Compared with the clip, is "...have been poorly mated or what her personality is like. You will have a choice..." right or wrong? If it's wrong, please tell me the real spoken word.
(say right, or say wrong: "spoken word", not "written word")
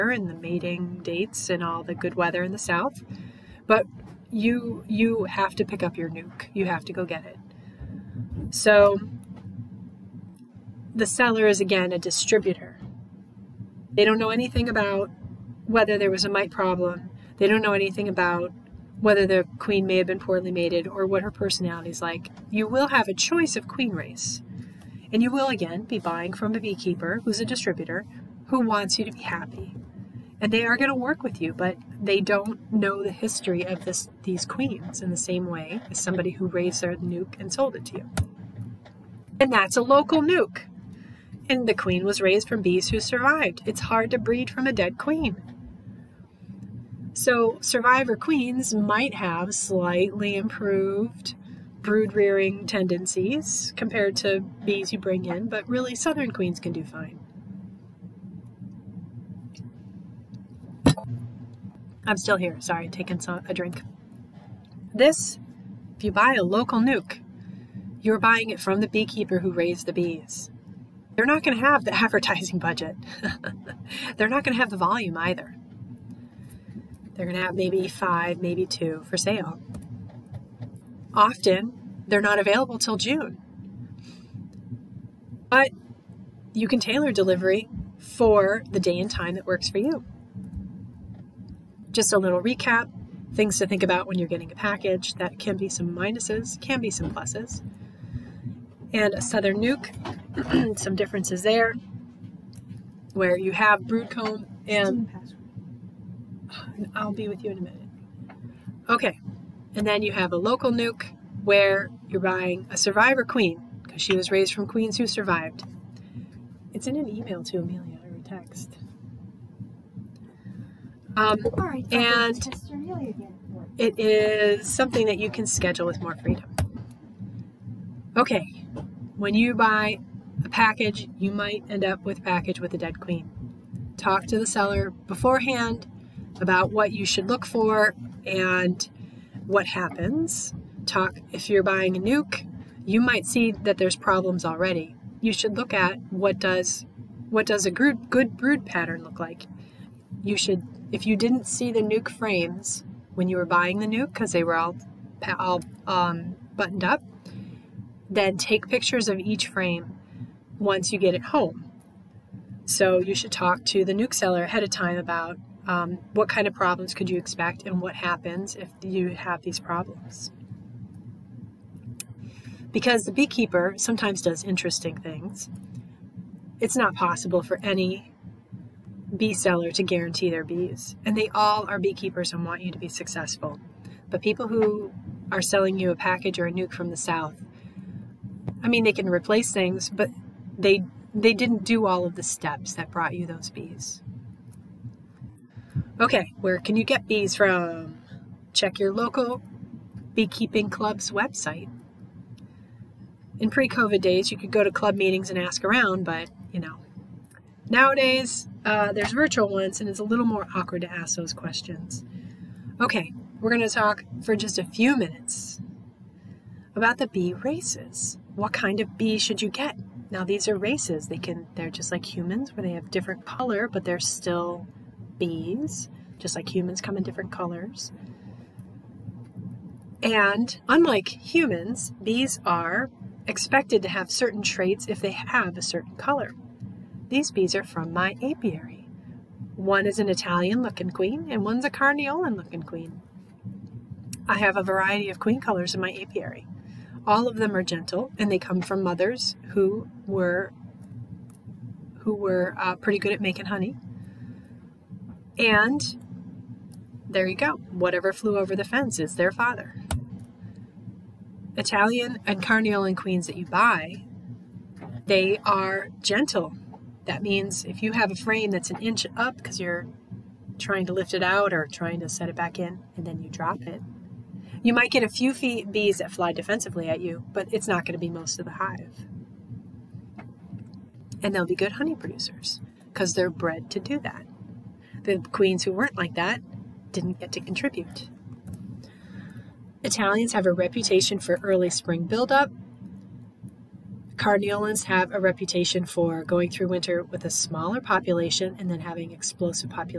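right.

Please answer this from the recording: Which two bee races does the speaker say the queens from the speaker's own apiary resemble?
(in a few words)
Italian and Carniolan.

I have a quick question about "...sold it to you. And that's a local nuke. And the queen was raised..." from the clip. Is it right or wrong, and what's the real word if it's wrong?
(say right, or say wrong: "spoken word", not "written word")
right.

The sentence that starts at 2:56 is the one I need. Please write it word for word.
It's not possible for any bee seller to guarantee their bees, and they all are beekeepers and want you to be successful.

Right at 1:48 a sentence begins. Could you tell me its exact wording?
Okay, and then you have a local nuke where you're buying a survivor queen because she was raised from queens who survived.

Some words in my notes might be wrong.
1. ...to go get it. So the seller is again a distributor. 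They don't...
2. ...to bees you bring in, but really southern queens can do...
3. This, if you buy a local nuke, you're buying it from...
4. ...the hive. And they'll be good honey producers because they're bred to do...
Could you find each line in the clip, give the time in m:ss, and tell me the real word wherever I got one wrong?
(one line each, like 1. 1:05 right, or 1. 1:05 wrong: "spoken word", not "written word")
1. 0:06 right
2. 0:54 right
3. 1:04 right
4. 4:38 right.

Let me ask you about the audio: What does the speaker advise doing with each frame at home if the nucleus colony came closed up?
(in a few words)
take pictures.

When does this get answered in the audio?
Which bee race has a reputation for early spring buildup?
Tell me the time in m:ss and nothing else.
4:49.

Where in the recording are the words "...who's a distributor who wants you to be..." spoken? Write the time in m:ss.
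0:27.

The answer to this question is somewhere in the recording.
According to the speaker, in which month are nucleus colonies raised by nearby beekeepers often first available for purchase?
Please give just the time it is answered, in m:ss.
1:22.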